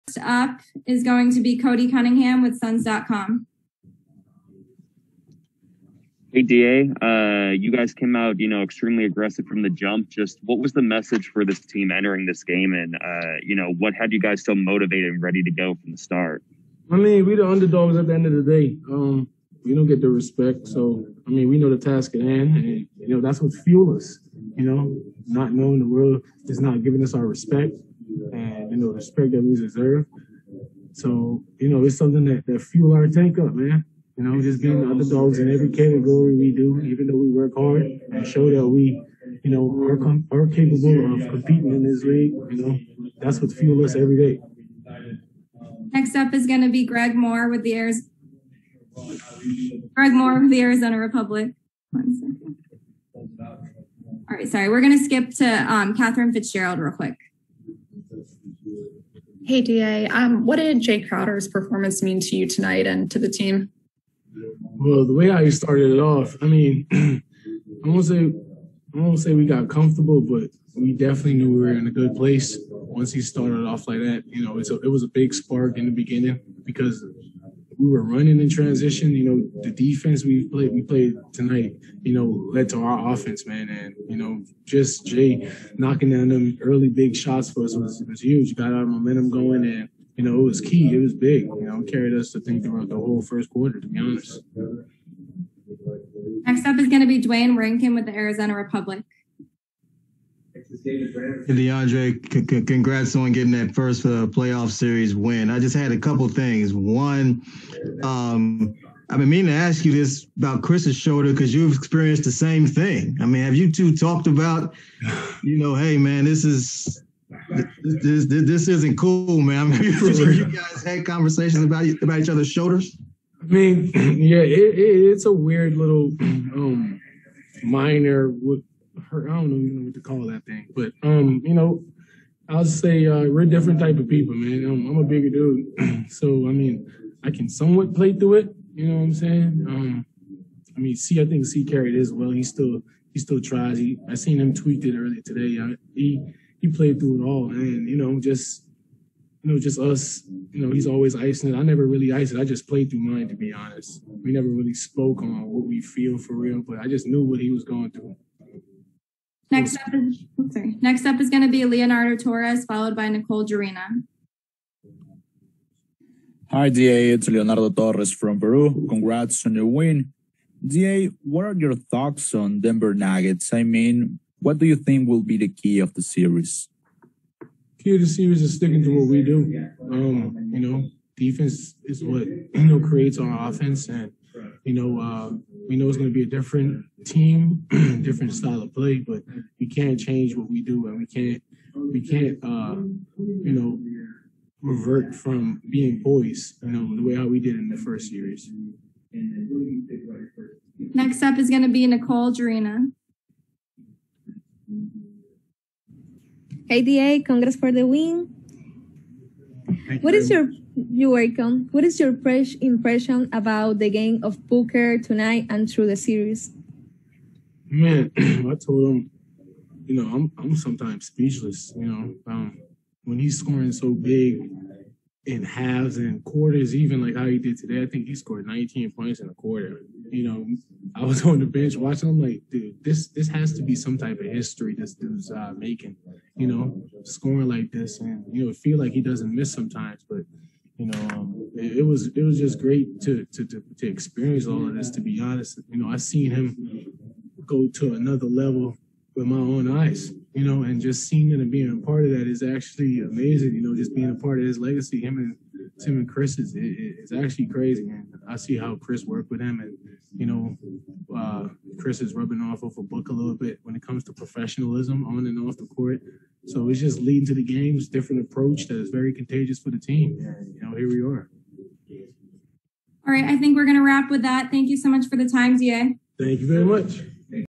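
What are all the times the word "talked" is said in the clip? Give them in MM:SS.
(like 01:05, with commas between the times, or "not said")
01:53.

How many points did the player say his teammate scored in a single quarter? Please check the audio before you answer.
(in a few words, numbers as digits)
19.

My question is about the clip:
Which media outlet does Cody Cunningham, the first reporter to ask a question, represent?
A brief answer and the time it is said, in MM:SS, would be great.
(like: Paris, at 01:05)
Suns.com, at 00:02.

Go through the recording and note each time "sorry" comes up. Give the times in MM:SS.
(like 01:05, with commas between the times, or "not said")
00:54, 02:40.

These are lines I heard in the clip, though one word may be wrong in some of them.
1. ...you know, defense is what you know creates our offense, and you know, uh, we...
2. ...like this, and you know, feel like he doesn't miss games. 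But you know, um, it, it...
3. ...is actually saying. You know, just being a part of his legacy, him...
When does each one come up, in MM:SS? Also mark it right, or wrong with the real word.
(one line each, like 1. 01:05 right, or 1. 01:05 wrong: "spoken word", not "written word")
1. 03:00 right
2. 03:57 wrong: "sometimes", not "games"
3. 04:12 wrong: "amazing", not "saying".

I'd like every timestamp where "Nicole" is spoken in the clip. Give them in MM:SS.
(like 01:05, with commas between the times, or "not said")
02:43, 03:21.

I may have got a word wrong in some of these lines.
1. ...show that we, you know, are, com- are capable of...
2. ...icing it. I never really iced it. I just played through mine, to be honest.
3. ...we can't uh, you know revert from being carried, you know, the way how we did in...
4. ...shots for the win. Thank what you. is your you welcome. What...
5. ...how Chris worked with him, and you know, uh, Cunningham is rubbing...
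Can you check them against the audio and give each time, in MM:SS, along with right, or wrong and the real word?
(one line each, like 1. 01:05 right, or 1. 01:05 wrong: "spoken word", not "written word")
1. 00:38 right
2. 02:31 right
3. 03:11 wrong: "poised", not "carried"
4. 03:27 wrong: "congrats", not "shots"
5. 04:18 wrong: "Chris", not "Cunningham".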